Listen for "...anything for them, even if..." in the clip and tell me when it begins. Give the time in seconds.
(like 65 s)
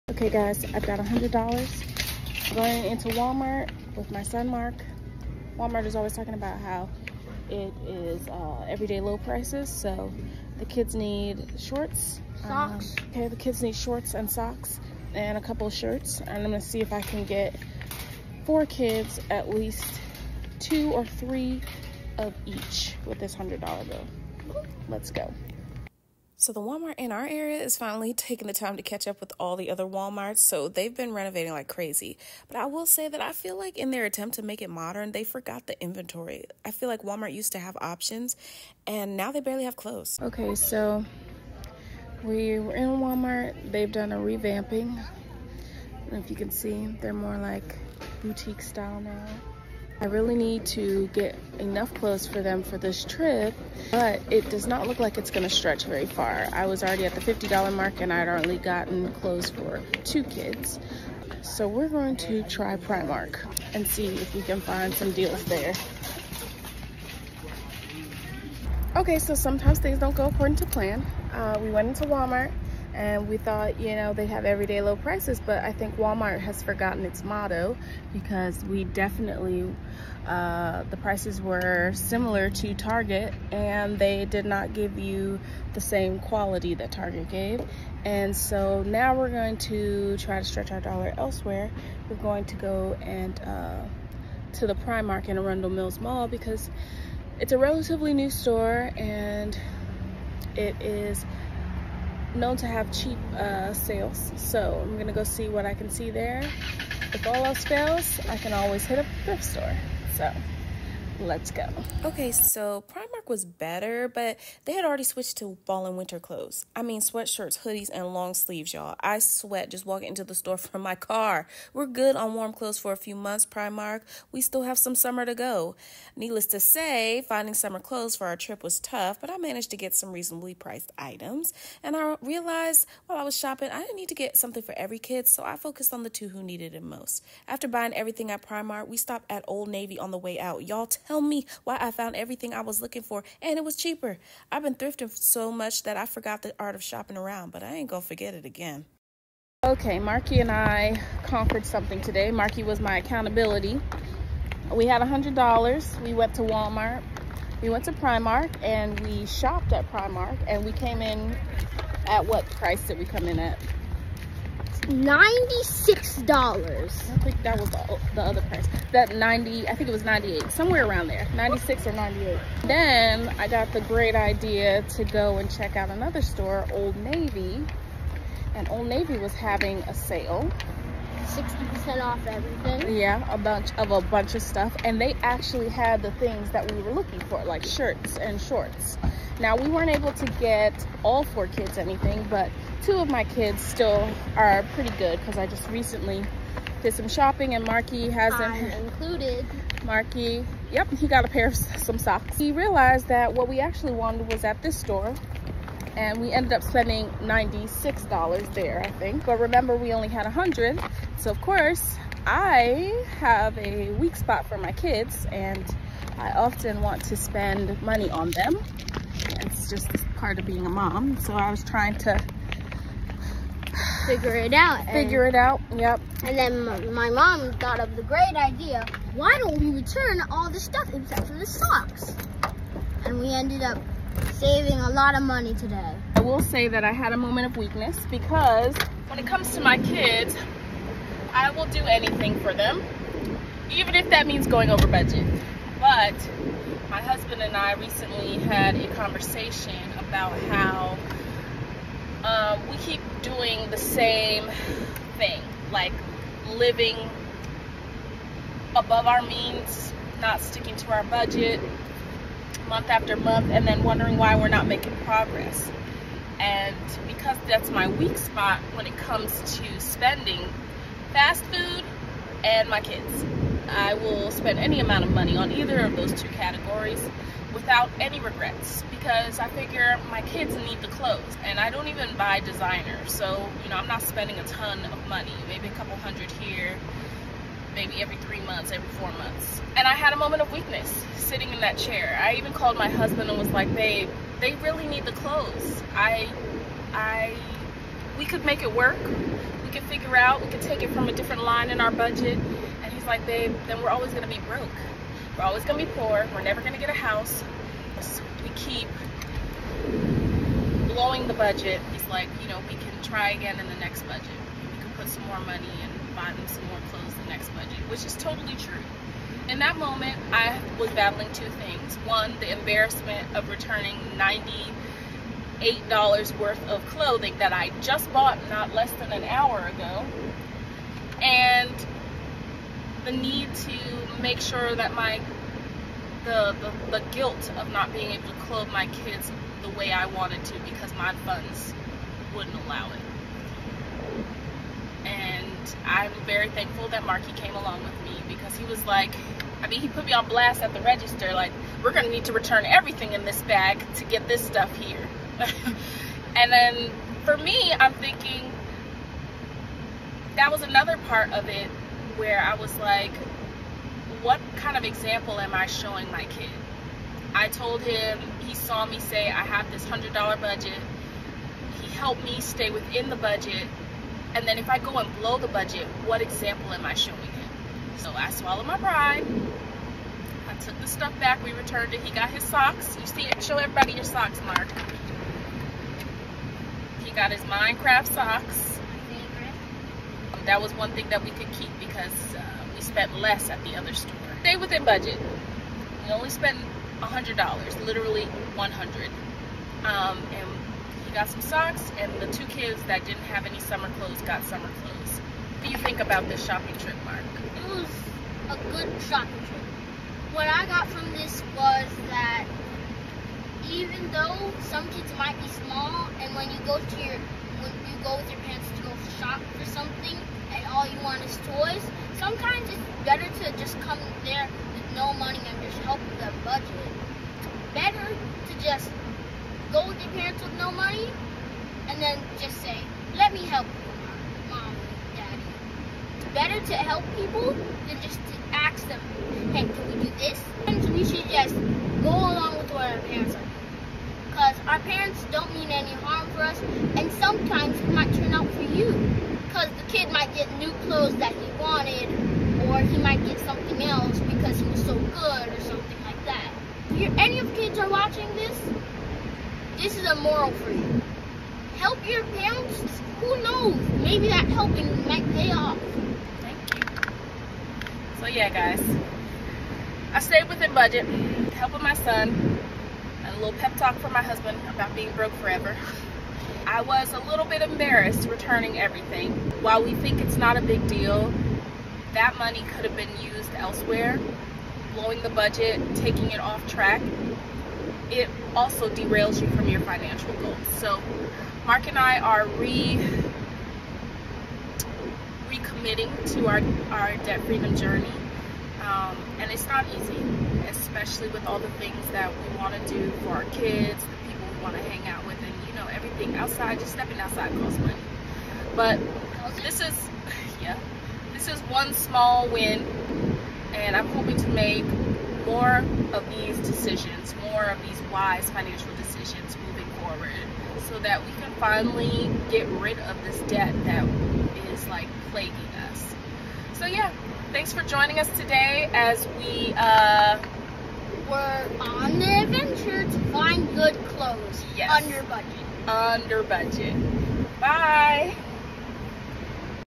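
241 s.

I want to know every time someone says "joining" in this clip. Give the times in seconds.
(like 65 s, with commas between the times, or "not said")
527 s.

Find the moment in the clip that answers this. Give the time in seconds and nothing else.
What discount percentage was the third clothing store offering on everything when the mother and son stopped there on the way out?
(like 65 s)
181 s.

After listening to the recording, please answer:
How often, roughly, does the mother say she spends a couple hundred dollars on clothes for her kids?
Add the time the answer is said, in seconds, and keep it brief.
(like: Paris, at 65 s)
every four months, at 288 s.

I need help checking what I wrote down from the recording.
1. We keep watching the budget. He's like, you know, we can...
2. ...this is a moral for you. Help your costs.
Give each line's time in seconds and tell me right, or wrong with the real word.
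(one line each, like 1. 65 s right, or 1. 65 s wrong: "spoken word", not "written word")
1. 308 s wrong: "blowing", not "watching"
2. 459 s wrong: "parents", not "costs".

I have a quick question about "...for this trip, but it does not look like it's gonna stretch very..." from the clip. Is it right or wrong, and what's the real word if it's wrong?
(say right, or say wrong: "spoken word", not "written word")
right.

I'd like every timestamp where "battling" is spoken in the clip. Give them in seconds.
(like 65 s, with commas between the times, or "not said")
320 s.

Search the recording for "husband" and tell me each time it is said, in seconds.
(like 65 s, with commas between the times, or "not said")
247 s, 292 s, 474 s.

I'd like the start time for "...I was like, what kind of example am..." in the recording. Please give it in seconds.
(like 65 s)
362 s.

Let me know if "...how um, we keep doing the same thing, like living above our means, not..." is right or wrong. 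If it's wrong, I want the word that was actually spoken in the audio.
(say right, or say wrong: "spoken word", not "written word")
right.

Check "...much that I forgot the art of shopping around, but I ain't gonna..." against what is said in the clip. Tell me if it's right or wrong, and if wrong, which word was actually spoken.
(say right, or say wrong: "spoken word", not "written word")
right.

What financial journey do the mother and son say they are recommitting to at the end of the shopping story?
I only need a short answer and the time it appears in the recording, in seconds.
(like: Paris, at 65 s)
debt freedom journey, at 497 s.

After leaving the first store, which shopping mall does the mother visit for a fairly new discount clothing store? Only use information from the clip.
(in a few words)
Arundel Mills.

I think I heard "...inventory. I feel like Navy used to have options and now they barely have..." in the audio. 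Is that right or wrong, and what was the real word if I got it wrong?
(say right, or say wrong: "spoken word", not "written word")
wrong: "Walmart", not "Navy".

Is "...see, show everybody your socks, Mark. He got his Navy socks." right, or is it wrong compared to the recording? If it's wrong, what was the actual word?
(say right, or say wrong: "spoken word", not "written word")
wrong: "Minecraft", not "Navy".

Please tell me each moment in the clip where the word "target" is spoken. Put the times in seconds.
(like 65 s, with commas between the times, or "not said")
82 s, 86 s.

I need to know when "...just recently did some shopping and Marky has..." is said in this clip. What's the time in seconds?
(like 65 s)
195 s.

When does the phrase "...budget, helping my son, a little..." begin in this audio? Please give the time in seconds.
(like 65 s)
470 s.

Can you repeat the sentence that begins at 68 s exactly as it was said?
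Okay, so sometimes things don't go according to plan.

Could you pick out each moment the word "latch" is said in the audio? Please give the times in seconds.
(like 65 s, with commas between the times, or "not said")
not said.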